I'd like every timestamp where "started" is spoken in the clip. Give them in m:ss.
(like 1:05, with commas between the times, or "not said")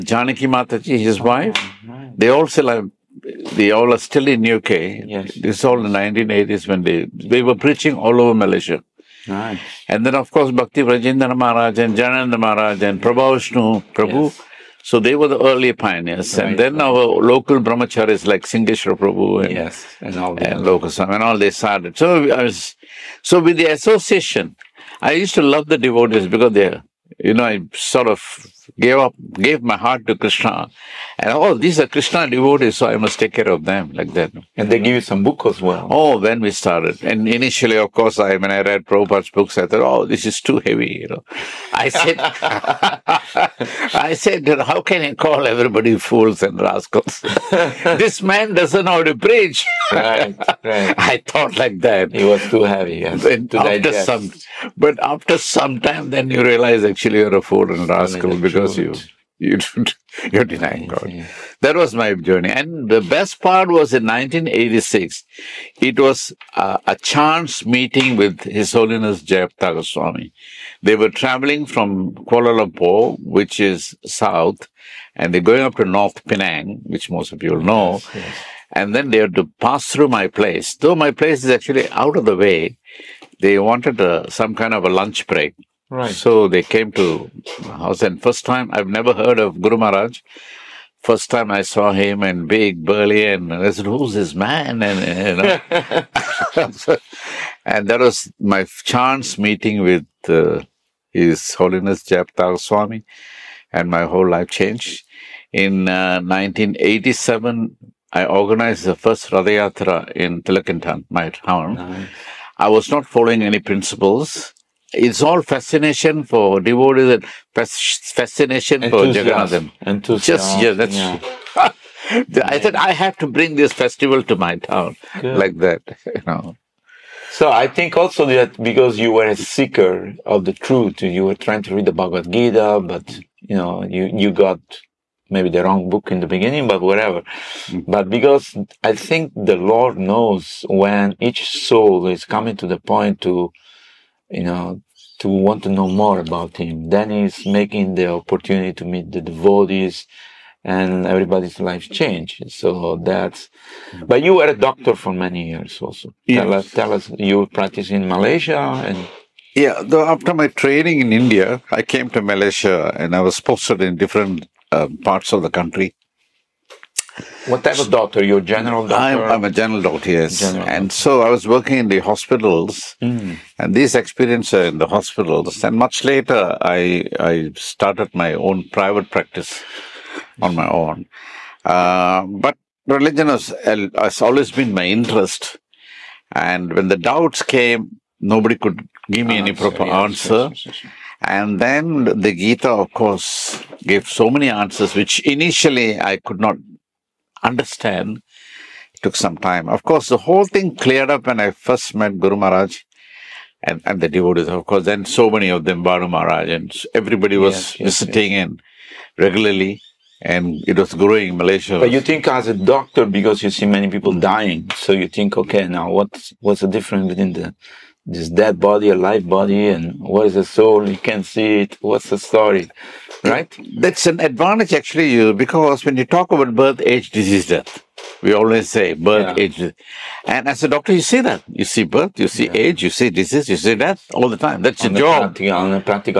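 0:21, 0:36, 2:57.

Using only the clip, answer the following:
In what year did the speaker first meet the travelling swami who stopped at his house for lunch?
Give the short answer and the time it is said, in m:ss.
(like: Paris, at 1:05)
1986, at 1:04.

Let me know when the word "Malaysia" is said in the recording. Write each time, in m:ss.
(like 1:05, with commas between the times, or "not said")
0:08, 2:38, 2:42, 3:31.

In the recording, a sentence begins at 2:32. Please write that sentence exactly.
So that's, but you were a doctor for many years also.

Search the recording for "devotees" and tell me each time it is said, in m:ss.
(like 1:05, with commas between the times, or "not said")
0:25, 0:32, 1:56, 2:29, 3:24.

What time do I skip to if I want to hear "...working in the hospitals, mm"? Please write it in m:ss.
2:51.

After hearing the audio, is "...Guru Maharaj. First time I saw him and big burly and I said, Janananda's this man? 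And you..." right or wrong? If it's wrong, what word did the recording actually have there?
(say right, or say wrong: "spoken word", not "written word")
wrong: "Who", not "Janananda".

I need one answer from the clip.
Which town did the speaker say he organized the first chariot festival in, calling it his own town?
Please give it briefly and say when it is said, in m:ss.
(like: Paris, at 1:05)
Teluk Intan, at 1:50.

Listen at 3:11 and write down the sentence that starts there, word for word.
And then the Gita, of course, gave so many answers, which initially I could not understand.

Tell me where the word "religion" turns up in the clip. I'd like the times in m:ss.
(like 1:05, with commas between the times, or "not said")
3:02.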